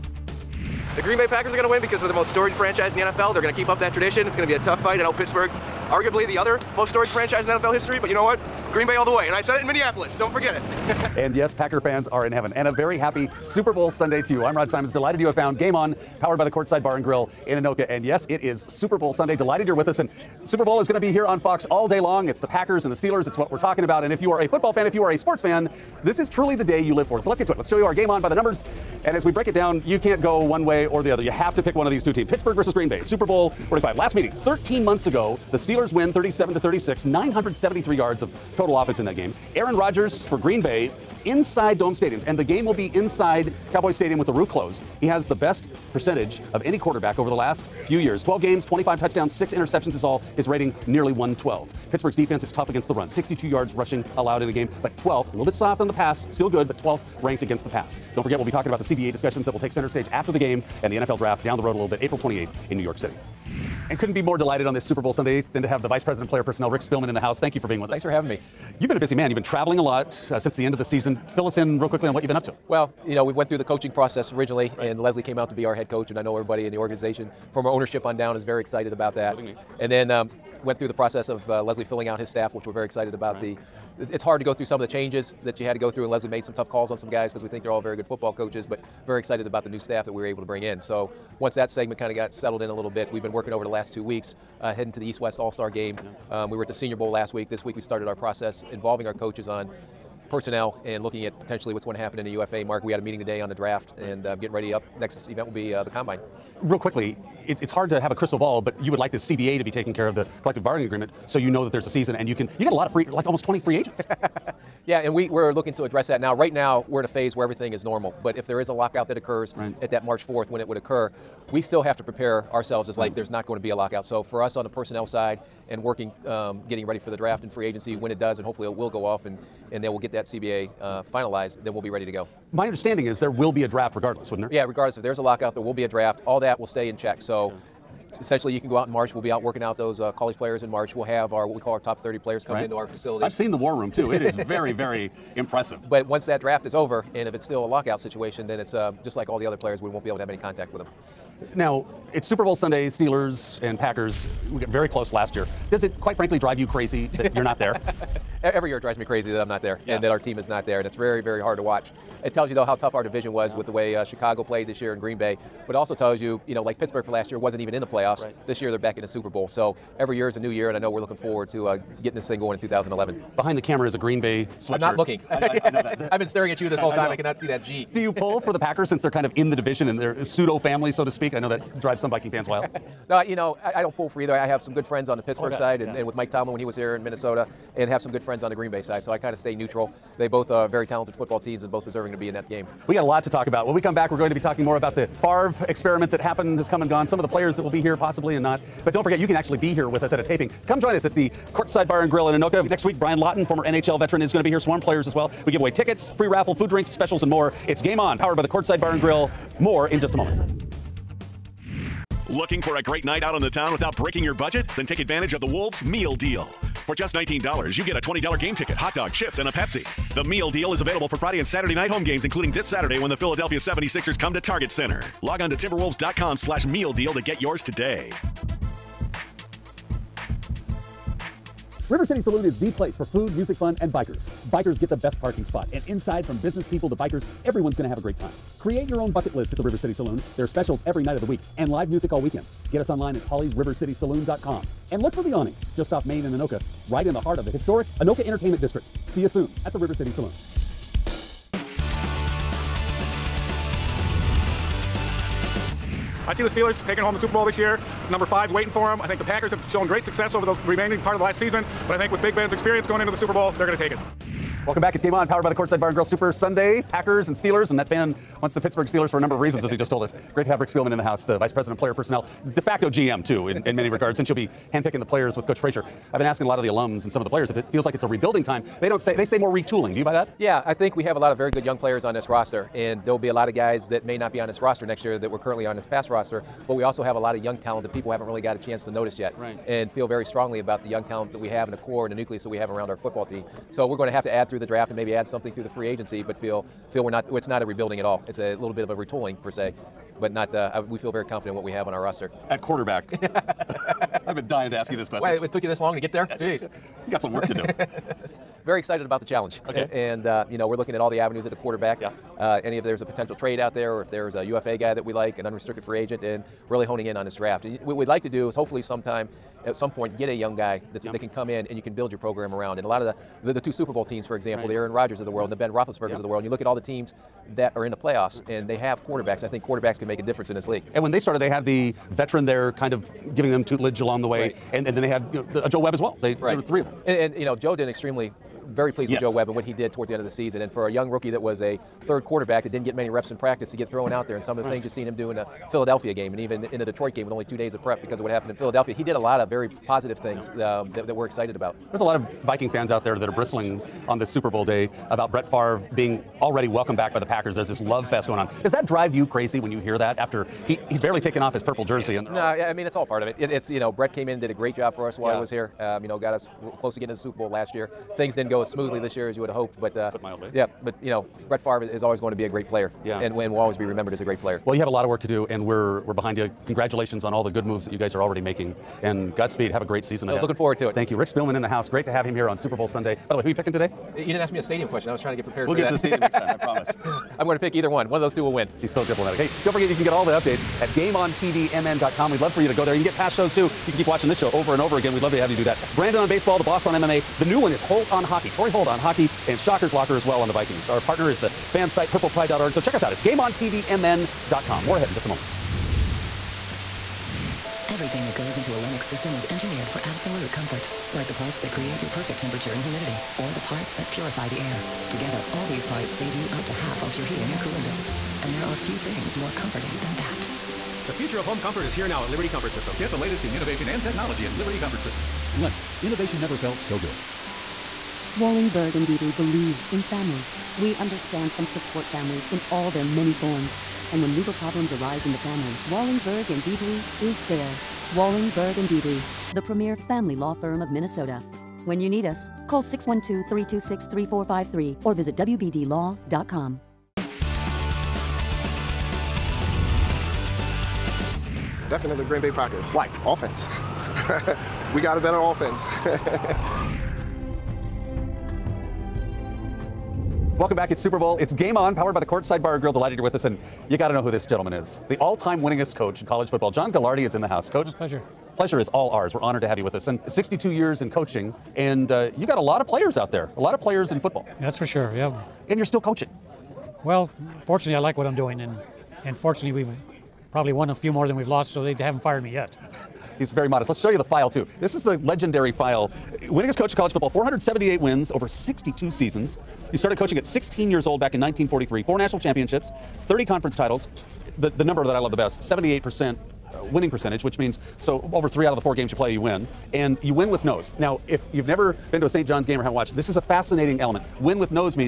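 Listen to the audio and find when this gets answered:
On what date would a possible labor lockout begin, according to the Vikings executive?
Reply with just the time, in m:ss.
2:00.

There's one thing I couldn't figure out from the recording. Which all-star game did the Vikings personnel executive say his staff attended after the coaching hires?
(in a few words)
East-West All-Star Game.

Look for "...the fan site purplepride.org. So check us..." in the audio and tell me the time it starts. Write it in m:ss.
6:41.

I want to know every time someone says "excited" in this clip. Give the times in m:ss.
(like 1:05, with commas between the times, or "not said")
1:18, 1:22, 1:29, 5:08, 5:51.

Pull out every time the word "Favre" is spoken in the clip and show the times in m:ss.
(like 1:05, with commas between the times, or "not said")
3:15, 5:55, 6:11.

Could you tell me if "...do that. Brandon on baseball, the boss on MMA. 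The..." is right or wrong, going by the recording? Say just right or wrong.
right.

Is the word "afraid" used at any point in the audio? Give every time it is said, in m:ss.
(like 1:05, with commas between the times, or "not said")
not said.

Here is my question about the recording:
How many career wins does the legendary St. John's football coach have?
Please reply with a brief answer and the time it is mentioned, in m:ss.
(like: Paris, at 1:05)
478, at 8:07.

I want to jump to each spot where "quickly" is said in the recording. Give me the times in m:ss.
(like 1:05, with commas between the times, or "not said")
1:11, 1:46.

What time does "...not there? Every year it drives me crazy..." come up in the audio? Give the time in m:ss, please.
2:37.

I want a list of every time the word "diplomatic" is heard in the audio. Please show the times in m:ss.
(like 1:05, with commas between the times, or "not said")
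6:29.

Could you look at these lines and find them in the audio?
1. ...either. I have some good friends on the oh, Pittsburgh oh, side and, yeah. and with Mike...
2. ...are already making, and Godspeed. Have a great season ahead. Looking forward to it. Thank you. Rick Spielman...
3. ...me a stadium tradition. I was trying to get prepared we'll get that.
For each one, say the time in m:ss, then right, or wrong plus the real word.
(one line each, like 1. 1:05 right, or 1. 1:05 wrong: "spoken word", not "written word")
1. 3:04 right
2. 6:18 right
3. 6:24 wrong: "question", not "tradition".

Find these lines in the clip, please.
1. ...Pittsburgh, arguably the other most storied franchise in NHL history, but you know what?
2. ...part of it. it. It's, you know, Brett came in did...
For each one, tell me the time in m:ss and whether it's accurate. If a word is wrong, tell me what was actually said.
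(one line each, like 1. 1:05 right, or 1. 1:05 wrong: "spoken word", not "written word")
1. 0:05 wrong: "NFL", not "NHL"
2. 6:03 right.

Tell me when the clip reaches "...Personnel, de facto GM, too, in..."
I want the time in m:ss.
4:31.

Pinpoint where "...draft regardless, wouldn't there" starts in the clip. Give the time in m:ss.
2:13.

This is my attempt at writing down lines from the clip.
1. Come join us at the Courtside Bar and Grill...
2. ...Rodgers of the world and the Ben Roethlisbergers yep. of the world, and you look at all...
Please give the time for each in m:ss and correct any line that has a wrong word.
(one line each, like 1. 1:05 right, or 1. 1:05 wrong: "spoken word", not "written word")
1. 3:20 right
2. 5:24 right.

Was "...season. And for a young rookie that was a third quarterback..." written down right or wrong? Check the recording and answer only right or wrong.
right.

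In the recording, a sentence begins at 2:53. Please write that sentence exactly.
Behind the camera is a Green Bay sweatshirt.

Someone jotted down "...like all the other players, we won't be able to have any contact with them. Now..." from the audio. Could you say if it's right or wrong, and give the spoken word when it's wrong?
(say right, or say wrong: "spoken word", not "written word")
right.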